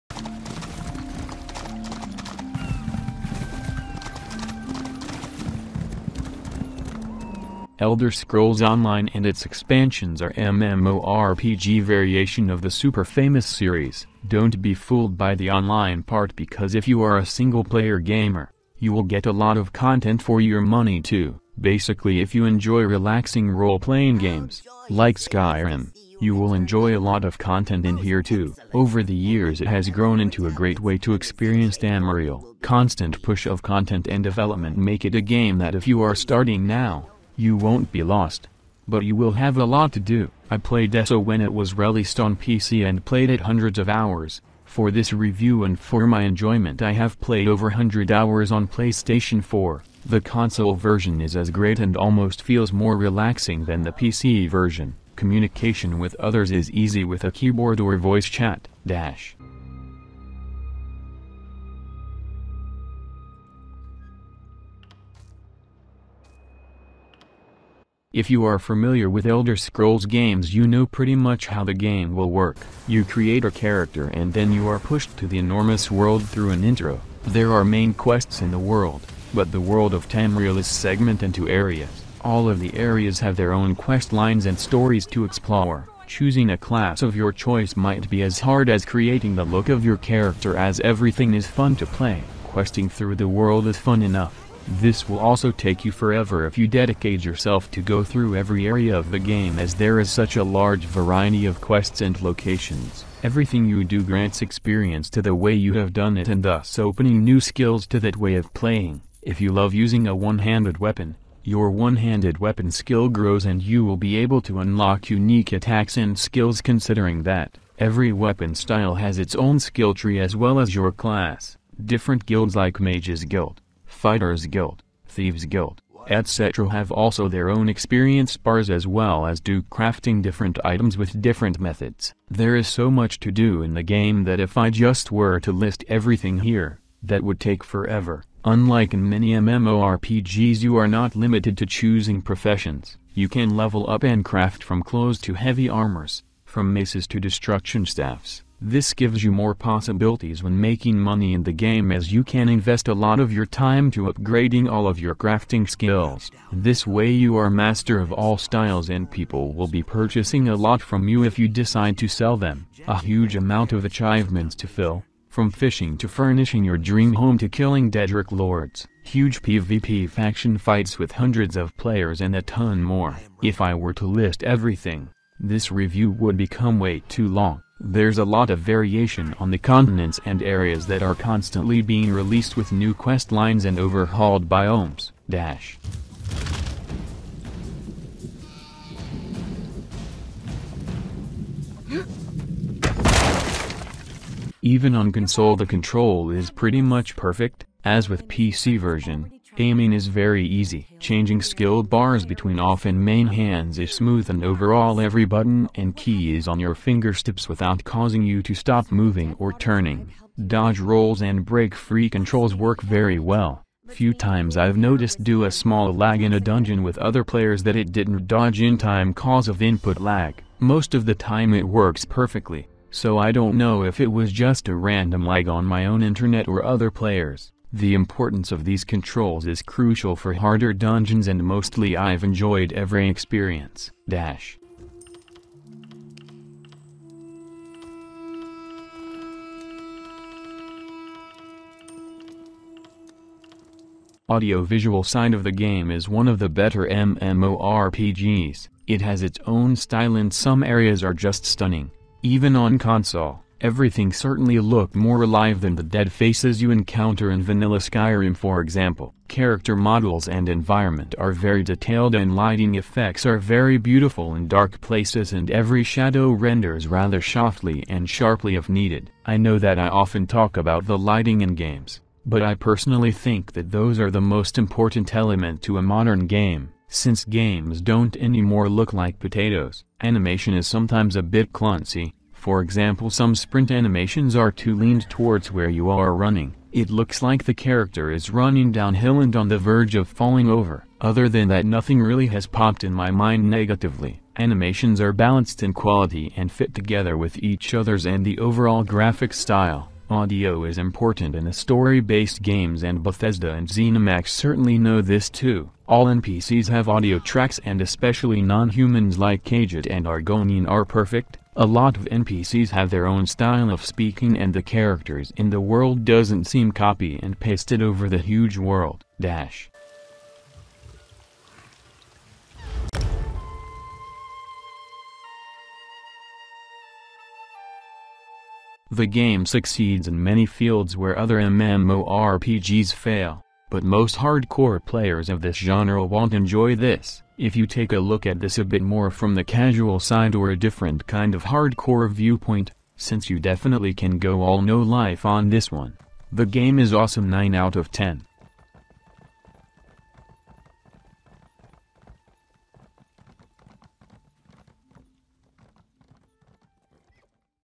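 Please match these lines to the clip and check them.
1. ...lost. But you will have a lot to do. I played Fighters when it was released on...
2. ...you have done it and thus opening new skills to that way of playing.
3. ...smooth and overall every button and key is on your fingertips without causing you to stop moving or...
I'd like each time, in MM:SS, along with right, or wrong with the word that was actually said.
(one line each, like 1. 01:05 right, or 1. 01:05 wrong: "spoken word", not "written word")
1. 00:38 wrong: "ESO", not "Fighters"
2. 01:45 right
3. 03:23 right.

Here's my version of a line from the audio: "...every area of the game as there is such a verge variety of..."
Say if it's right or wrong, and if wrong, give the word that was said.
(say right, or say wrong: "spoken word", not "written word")
wrong: "large", not "verge".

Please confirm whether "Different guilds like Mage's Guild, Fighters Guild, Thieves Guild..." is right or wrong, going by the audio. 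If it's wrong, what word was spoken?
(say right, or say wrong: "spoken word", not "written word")
right.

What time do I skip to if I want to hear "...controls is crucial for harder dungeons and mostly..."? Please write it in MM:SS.
03:48.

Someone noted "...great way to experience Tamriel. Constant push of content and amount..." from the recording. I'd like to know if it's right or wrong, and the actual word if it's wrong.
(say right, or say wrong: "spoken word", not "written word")
wrong: "development", not "amount".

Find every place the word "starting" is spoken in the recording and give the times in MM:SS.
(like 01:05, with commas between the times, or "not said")
00:36.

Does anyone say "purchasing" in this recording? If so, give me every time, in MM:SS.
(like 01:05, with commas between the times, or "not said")
02:39.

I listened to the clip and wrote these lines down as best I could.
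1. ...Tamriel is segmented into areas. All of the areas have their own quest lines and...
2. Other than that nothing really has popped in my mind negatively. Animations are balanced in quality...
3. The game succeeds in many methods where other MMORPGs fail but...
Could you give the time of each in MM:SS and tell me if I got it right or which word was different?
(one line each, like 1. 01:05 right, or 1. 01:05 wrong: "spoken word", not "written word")
1. 01:20 right
2. 04:51 right
3. 05:28 wrong: "fields", not "methods".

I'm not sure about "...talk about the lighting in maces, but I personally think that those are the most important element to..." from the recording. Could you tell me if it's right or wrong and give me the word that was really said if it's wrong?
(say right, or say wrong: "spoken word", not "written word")
wrong: "games", not "maces".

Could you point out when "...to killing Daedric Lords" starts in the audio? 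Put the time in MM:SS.
02:47.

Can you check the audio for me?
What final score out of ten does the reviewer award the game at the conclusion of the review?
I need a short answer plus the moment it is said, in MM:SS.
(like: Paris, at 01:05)
9, at 05:47.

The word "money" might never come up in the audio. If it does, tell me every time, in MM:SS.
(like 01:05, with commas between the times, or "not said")
00:20, 02:30.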